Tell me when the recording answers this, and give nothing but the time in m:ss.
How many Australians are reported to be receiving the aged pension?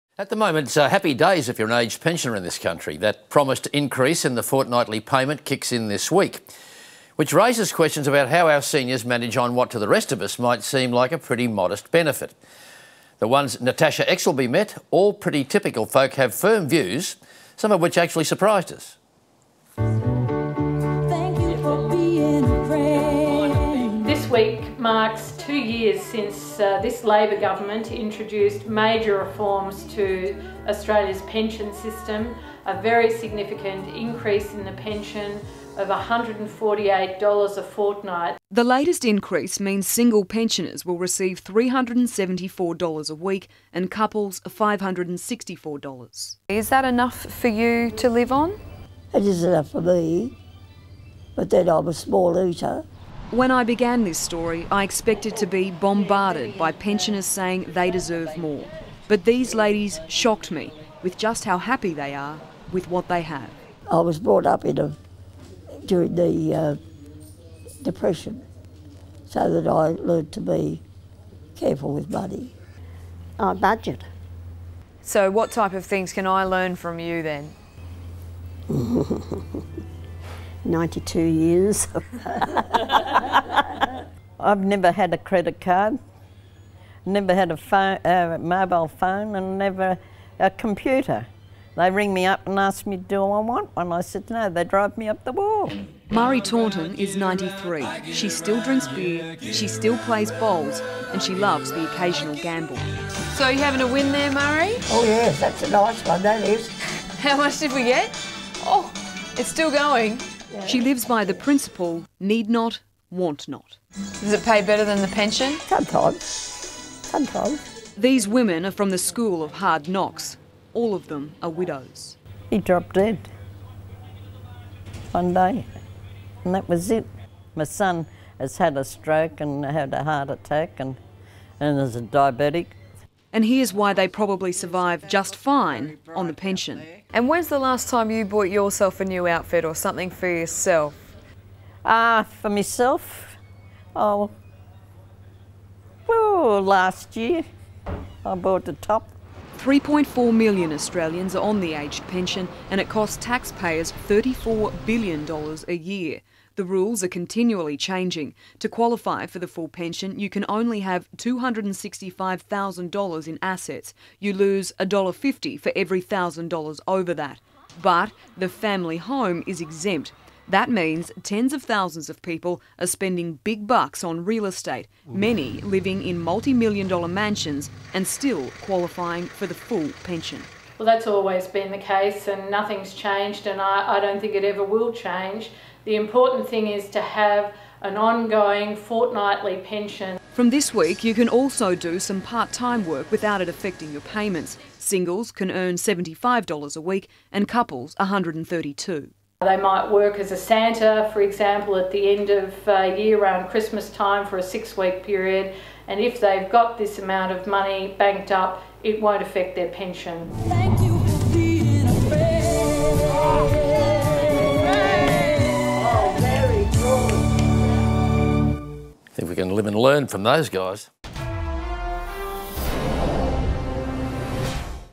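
2:29.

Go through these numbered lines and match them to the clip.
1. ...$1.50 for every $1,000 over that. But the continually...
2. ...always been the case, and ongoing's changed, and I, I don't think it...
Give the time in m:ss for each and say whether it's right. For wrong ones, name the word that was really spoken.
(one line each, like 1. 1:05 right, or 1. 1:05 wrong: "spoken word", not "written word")
1. 2:44 wrong: "family", not "continually"
2. 3:01 wrong: "nothing", not "ongoing".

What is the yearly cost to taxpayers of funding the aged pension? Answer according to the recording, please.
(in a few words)
$34 billion.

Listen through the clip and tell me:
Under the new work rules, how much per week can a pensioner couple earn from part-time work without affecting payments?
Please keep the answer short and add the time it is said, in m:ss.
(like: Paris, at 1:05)
$132, at 3:17.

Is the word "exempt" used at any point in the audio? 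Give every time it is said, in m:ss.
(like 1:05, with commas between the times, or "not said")
2:49.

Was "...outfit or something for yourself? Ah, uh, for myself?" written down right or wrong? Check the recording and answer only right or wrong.
right.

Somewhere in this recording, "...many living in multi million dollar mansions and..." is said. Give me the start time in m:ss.
2:55.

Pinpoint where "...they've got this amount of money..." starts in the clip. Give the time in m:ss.
3:26.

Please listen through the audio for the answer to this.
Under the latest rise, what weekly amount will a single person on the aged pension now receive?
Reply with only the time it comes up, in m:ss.
0:41.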